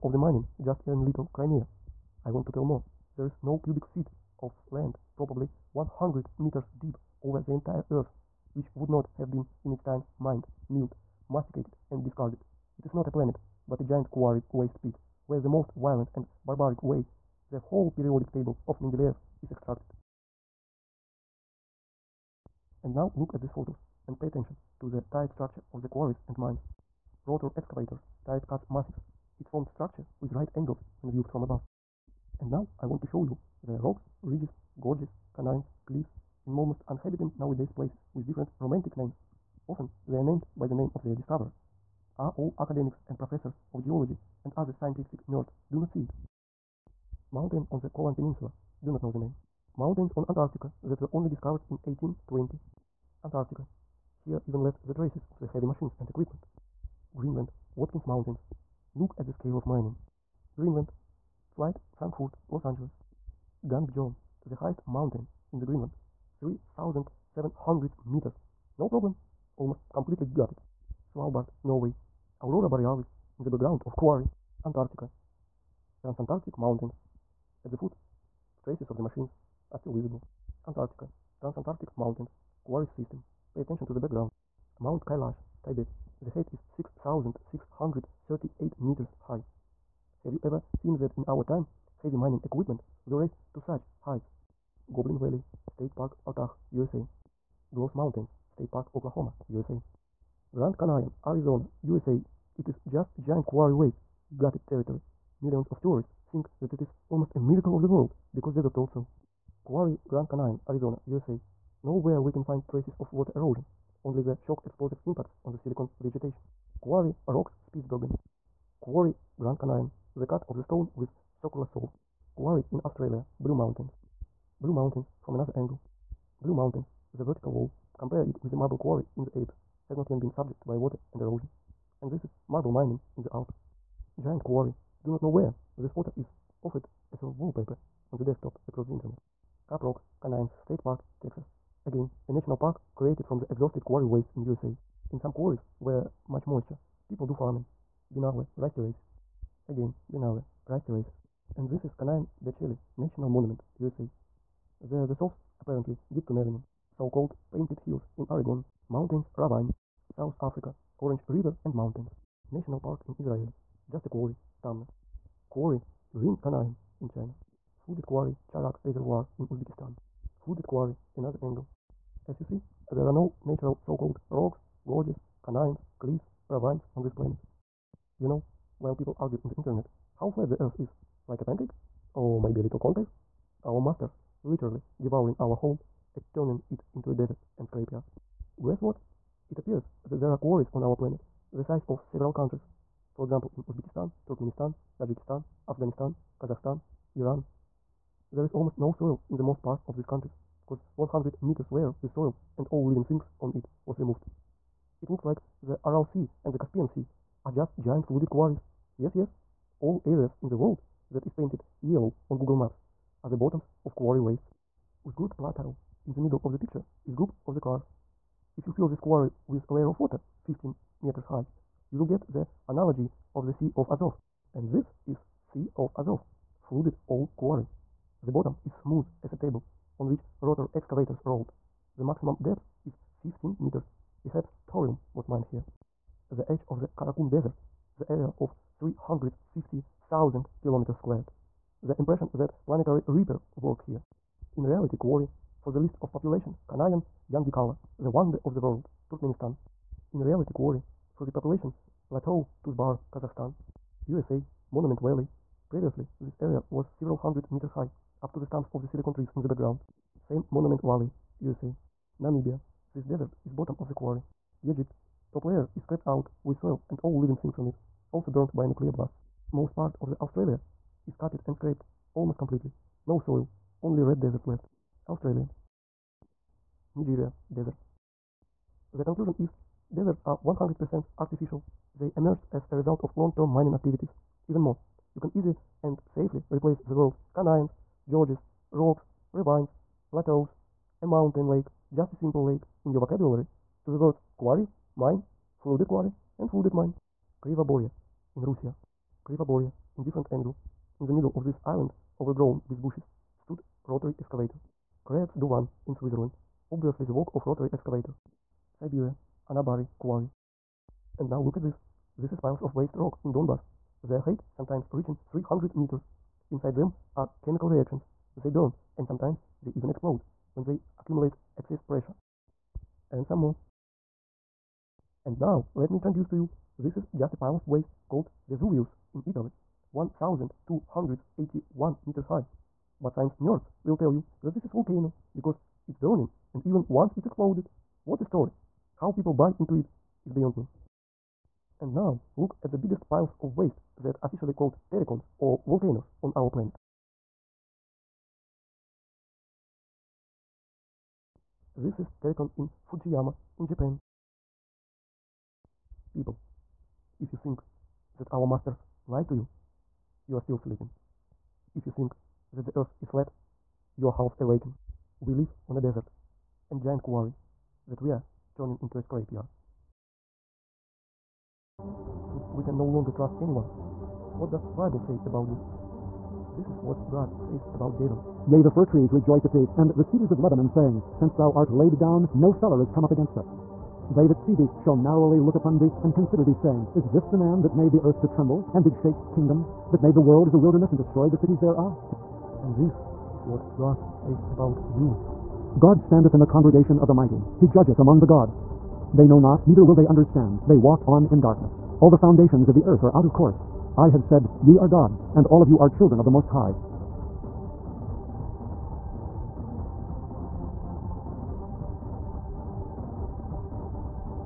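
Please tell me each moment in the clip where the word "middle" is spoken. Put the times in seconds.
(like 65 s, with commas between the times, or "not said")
216 s, 301 s.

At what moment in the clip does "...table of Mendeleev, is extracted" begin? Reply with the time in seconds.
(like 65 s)
18 s.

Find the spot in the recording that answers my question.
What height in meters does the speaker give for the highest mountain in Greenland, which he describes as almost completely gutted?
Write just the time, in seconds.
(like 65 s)
66 s.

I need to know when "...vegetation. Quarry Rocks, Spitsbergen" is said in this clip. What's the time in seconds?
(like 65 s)
116 s.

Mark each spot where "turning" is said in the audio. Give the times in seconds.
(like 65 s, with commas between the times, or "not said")
186 s, 368 s.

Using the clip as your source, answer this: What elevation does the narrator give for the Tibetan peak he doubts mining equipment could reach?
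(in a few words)
6,638 meters.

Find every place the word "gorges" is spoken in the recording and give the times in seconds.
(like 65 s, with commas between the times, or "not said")
34 s, 174 s, 288 s.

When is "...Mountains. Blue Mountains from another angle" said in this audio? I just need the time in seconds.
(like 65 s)
123 s.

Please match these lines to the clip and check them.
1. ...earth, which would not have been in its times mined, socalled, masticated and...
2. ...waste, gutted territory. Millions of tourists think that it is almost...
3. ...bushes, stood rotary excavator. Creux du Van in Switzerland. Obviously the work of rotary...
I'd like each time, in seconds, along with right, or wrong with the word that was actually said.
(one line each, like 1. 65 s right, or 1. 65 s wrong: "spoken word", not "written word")
1. 7 s wrong: "milled", not "socalled"
2. 103 s right
3. 302 s right.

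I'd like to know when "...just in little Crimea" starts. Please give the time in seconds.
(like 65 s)
0 s.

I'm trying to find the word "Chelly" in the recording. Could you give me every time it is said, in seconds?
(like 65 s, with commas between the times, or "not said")
152 s.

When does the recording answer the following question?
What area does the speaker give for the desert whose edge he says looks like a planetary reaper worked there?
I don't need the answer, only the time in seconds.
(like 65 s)
238 s.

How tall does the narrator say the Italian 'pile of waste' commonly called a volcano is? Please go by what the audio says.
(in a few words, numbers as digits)
1281 meters.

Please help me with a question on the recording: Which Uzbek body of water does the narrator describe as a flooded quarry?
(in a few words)
Charvak Reservoir.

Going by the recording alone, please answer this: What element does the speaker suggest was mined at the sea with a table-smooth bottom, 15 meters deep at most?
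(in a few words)
Thorium.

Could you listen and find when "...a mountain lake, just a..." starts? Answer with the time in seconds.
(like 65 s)
291 s.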